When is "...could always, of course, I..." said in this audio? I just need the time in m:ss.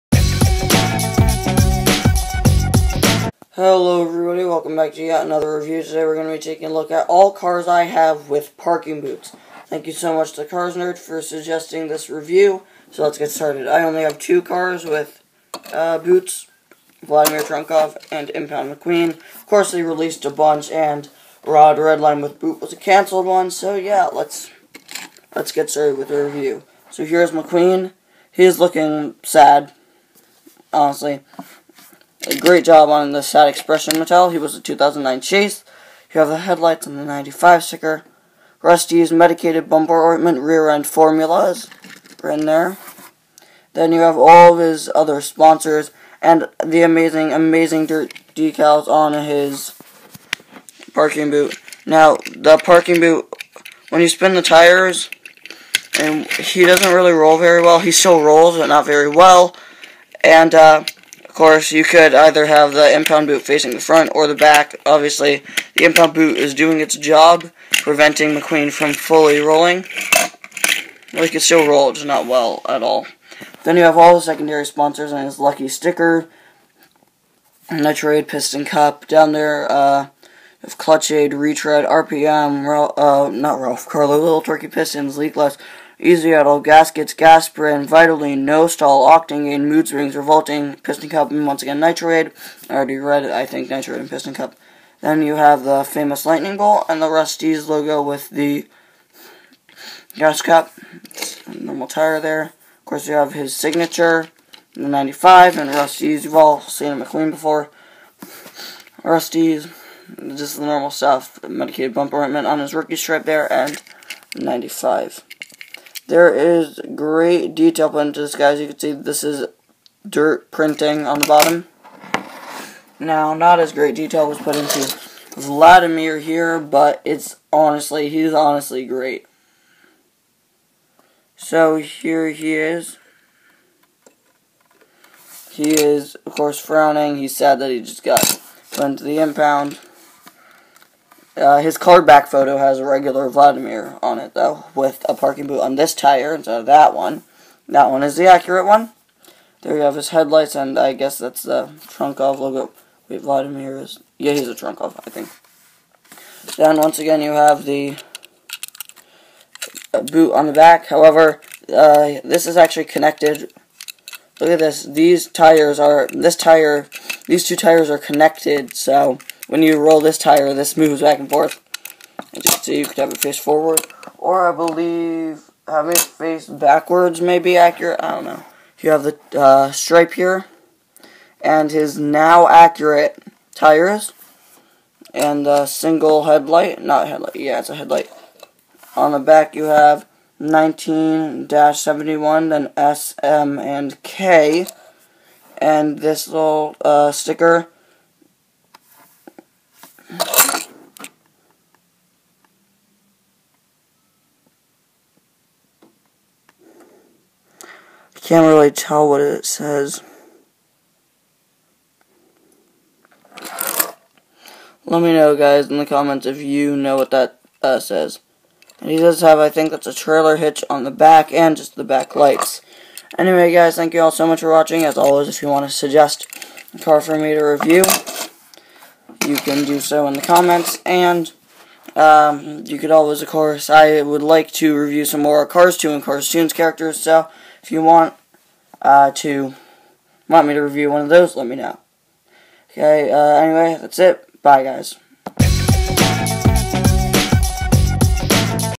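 3:52.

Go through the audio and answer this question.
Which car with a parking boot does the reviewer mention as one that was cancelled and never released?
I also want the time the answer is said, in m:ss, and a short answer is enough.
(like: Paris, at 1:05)
Rod Redline, at 0:21.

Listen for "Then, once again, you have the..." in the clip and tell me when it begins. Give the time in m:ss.
2:36.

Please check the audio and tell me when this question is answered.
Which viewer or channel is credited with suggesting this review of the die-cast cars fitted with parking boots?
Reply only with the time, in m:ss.
0:10.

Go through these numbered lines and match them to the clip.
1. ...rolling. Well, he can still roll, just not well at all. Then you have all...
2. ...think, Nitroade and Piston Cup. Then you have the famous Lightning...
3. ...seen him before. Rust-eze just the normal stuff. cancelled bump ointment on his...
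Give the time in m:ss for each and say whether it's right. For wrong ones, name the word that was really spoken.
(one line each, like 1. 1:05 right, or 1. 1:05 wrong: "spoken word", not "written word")
1. 1:09 right
2. 1:33 right
3. 1:46 wrong: "medicated", not "cancelled".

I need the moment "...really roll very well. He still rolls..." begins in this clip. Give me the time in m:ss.
0:56.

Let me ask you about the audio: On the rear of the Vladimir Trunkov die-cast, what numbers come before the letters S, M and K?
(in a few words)
19-71.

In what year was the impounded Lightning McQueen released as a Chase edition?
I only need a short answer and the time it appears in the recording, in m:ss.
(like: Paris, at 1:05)
2009, at 0:34.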